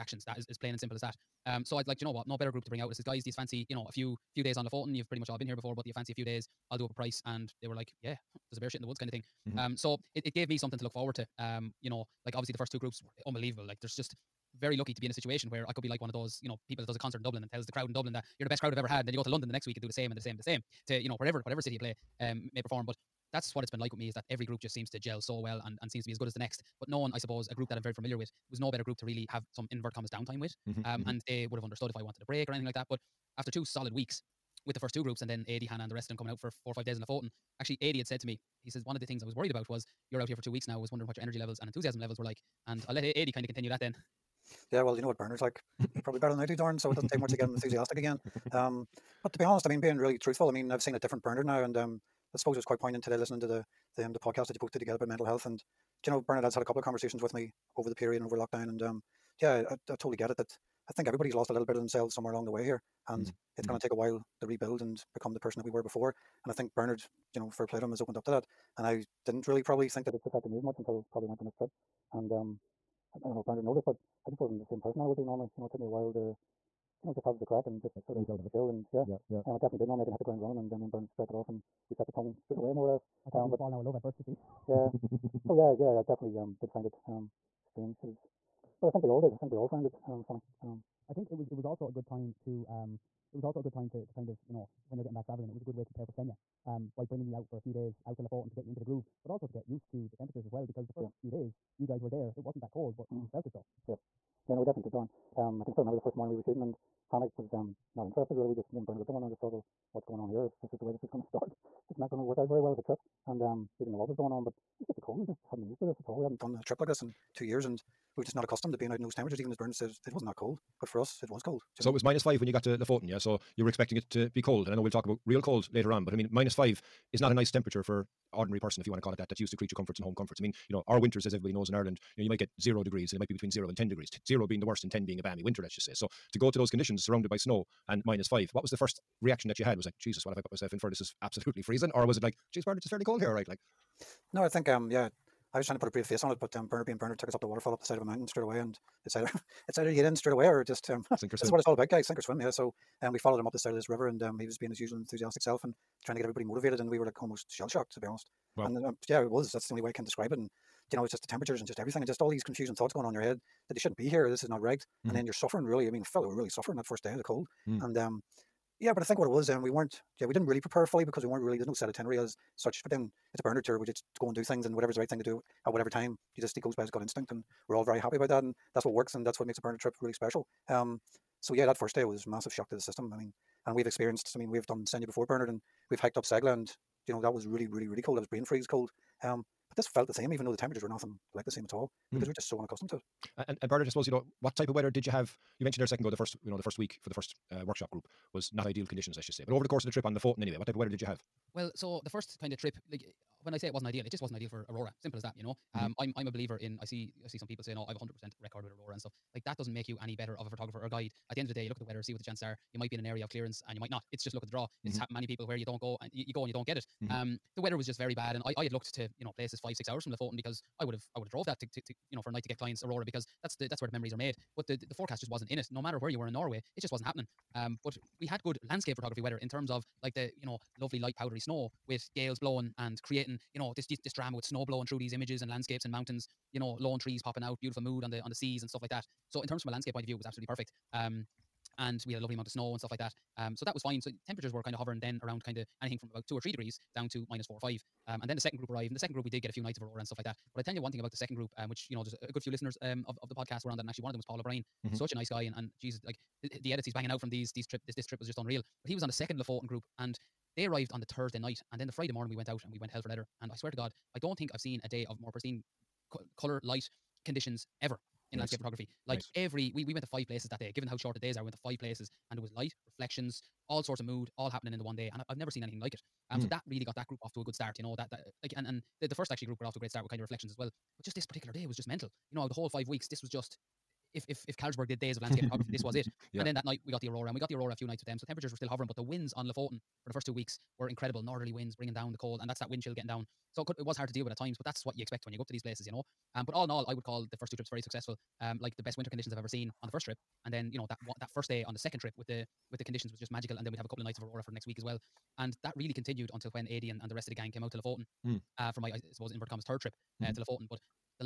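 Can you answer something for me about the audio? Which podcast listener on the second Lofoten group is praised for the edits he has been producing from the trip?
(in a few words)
Paul O'Brien.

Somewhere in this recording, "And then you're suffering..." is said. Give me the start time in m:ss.
2:45.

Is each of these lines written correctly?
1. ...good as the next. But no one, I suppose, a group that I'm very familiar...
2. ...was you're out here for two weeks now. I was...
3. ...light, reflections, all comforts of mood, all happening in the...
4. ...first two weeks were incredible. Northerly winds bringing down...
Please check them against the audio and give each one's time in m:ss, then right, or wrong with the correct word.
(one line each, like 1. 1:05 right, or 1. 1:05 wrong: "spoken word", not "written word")
1. 0:26 right
2. 0:39 right
3. 4:32 wrong: "sorts", not "comforts"
4. 4:50 right.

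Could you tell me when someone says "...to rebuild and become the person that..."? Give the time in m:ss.
1:04.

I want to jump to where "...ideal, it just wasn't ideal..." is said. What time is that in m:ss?
3:23.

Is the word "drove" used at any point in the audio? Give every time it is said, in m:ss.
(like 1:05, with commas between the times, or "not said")
3:41.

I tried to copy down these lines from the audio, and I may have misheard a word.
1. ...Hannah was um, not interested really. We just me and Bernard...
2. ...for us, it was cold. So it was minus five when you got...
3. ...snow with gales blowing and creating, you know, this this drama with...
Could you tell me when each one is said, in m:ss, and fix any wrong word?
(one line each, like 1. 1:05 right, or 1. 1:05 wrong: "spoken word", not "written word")
1. 1:47 right
2. 2:00 right
3. 3:51 right.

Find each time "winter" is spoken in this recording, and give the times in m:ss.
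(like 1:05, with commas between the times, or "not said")
2:10, 2:15, 4:58.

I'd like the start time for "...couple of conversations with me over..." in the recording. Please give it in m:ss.
0:56.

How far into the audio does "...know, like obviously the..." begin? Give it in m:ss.
0:11.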